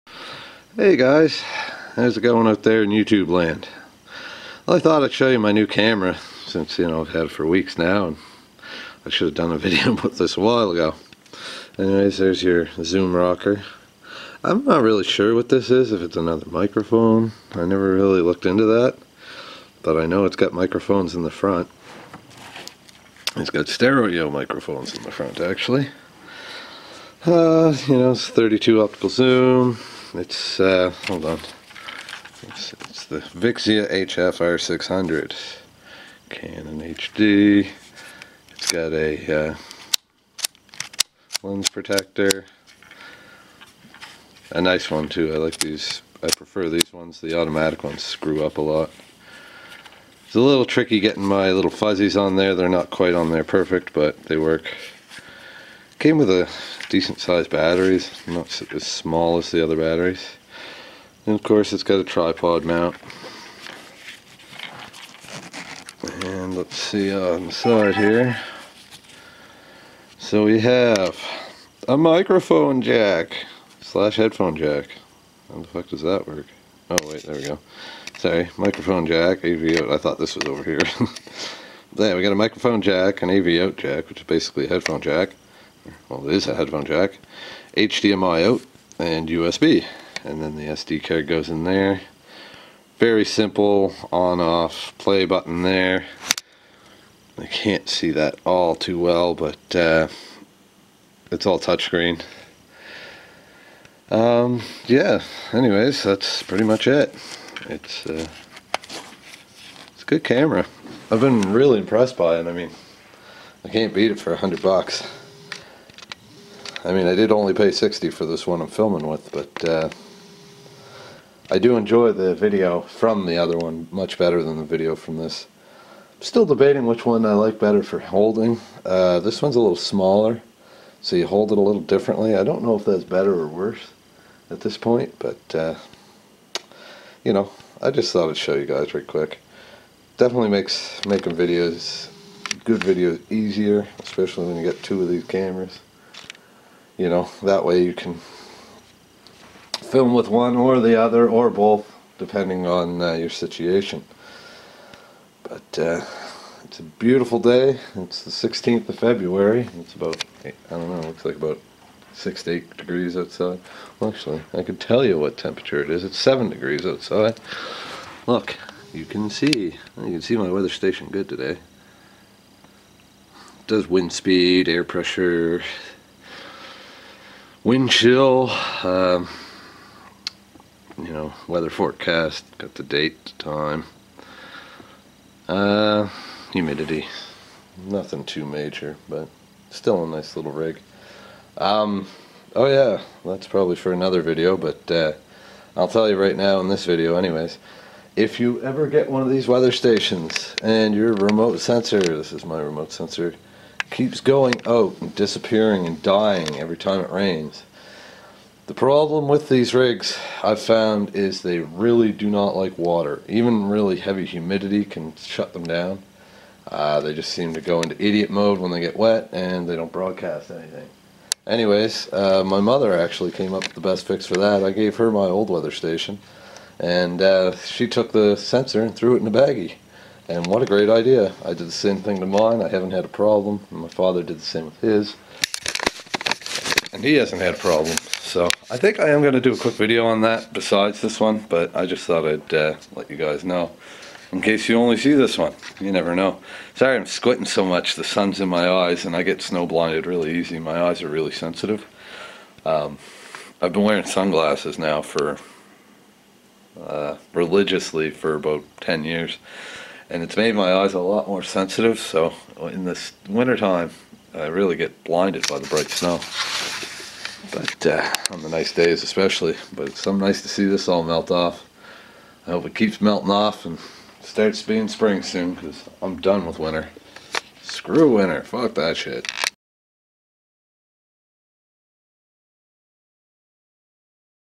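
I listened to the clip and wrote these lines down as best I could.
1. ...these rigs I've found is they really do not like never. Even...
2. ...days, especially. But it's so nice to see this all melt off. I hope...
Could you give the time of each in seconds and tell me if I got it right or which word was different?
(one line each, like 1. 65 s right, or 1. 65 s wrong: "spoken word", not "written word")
1. 209 s wrong: "water", not "never"
2. 268 s right.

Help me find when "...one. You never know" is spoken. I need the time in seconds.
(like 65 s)
245 s.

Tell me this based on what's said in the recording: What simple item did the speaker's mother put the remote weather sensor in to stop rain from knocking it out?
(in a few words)
A baggie.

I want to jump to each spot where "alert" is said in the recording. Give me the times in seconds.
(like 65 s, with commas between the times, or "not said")
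not said.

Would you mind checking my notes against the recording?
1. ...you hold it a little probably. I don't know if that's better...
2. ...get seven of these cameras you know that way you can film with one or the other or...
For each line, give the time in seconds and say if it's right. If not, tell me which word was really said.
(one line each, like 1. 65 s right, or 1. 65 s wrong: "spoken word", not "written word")
1. 131 s wrong: "differently", not "probably"
2. 144 s wrong: "two", not "seven".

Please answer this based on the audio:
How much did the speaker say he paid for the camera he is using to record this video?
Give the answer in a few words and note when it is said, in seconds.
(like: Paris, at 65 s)
60, at 117 s.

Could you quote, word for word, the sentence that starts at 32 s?
It's, it's the Vixia HFR 600 Canon HD.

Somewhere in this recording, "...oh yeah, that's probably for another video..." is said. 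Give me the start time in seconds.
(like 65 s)
192 s.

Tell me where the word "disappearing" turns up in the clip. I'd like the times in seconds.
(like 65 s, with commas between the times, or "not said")
205 s.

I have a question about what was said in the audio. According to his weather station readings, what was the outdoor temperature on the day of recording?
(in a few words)
7 degrees.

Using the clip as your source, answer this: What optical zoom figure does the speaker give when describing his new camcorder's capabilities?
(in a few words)
32.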